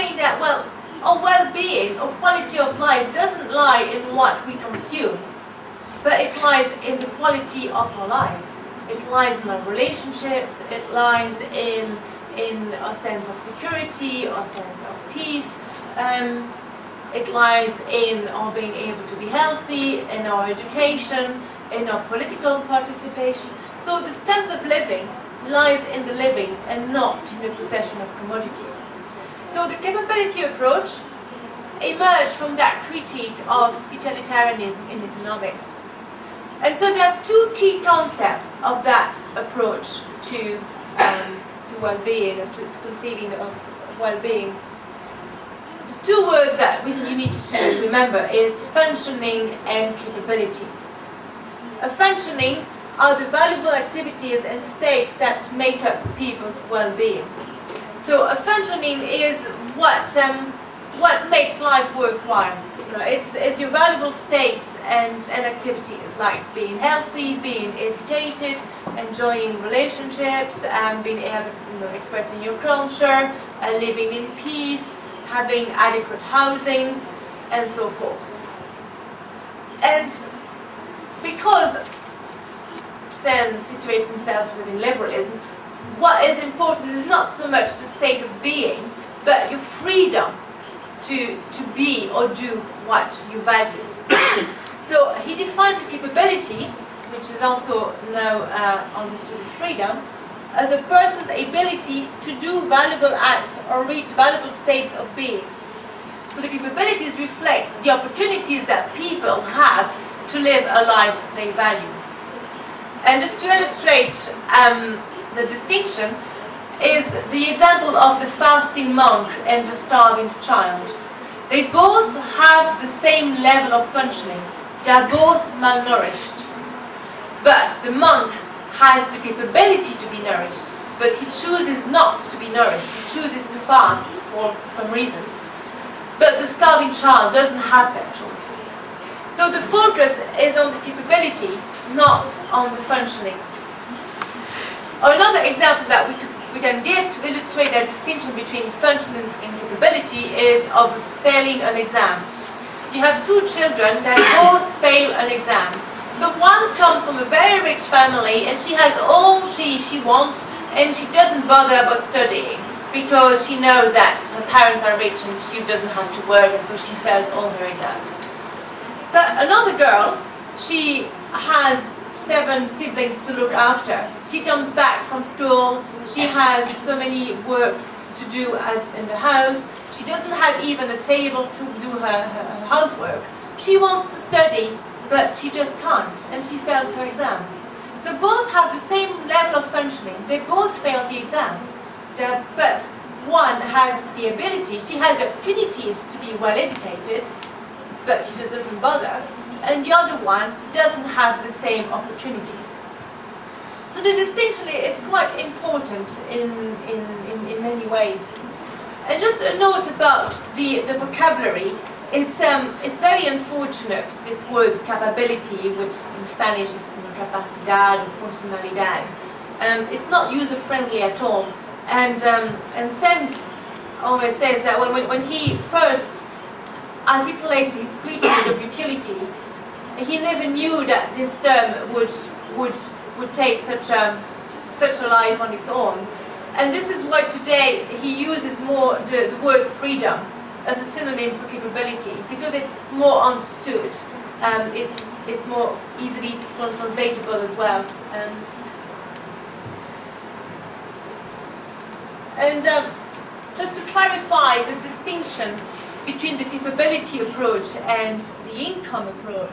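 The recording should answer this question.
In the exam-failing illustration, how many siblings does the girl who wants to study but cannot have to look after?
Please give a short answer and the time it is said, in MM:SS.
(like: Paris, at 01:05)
7, at 02:52.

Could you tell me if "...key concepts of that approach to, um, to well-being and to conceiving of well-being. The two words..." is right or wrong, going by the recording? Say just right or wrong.
right.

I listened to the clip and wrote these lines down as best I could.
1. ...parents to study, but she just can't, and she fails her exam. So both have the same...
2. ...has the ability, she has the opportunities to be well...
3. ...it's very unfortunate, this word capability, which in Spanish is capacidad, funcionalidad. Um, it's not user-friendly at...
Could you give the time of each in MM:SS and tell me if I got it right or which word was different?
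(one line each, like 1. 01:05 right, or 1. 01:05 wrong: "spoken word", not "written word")
1. 03:03 wrong: "wants", not "parents"
2. 03:13 right
3. 03:32 right.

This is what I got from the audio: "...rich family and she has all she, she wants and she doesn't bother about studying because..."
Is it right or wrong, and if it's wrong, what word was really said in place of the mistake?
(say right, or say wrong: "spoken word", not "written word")
right.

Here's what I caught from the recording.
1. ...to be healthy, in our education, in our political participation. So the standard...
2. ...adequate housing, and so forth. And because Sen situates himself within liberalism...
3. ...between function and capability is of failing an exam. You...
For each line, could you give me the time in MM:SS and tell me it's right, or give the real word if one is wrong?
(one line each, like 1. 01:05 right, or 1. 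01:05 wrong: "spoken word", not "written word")
1. 00:19 right
2. 01:15 right
3. 02:28 right.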